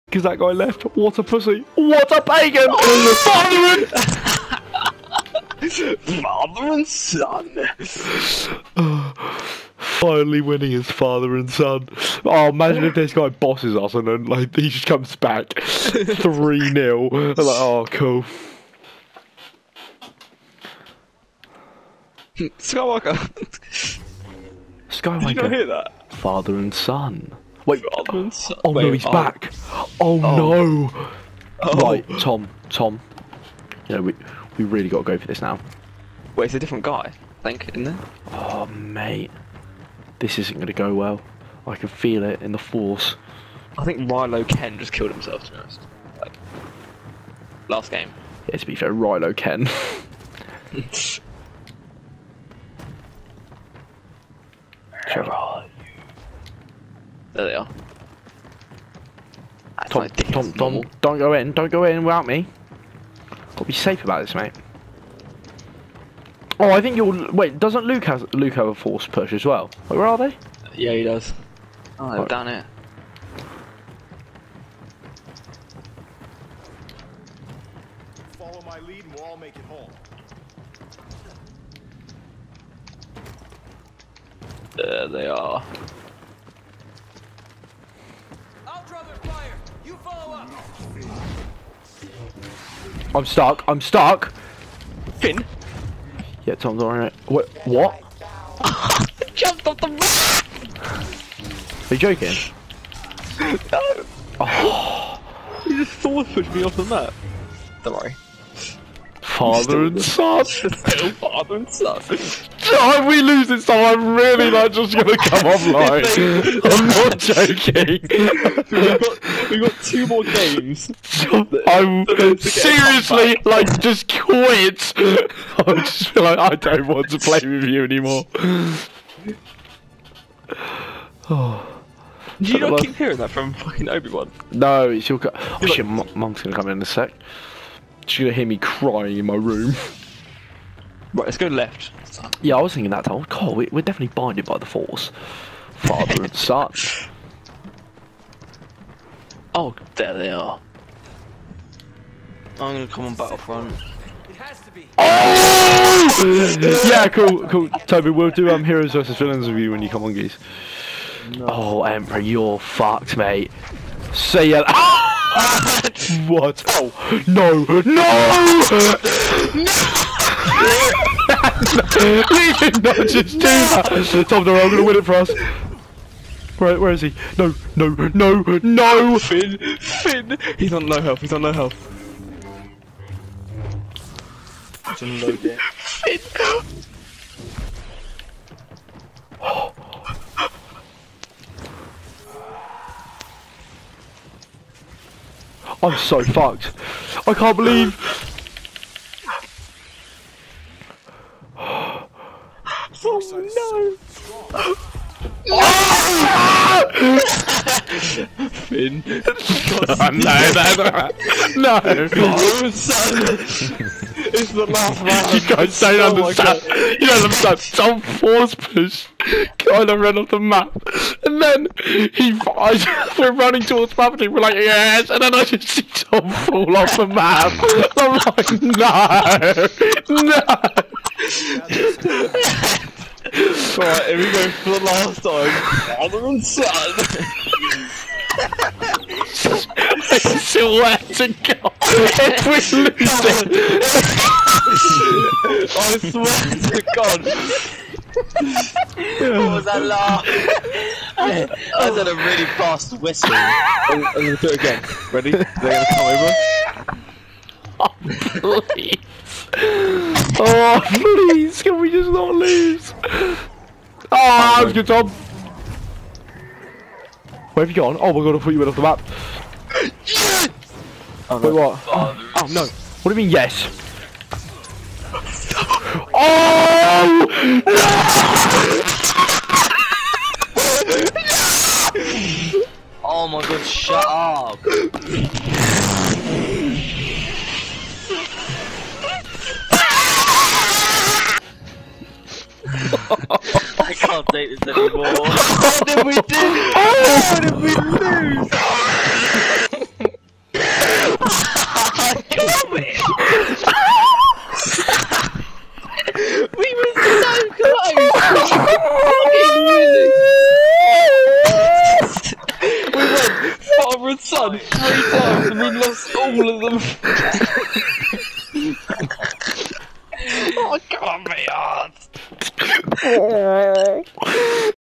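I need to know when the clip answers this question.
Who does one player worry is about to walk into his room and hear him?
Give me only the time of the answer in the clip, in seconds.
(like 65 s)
135 s.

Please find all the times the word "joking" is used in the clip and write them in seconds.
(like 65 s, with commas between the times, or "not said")
101 s, 117 s.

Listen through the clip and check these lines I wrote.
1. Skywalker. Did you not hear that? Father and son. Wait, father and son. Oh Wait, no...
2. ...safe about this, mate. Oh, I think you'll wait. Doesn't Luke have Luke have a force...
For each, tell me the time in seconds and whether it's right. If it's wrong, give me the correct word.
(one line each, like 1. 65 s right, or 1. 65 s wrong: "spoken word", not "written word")
1. 24 s right
2. 63 s right.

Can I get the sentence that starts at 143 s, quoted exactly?
Cole, we, are definitely binded by the force.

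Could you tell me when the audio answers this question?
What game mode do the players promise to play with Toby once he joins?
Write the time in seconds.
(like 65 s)
158 s.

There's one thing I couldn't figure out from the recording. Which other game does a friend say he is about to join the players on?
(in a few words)
Battlefront.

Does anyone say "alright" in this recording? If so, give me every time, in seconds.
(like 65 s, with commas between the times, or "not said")
96 s.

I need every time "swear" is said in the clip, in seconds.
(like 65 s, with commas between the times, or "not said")
240 s, 246 s.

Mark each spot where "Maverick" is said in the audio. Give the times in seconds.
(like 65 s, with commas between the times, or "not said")
223 s.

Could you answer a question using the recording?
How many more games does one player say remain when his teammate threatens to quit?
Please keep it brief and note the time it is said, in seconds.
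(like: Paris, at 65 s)
2, at 119 s.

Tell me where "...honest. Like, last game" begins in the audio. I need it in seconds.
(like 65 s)
45 s.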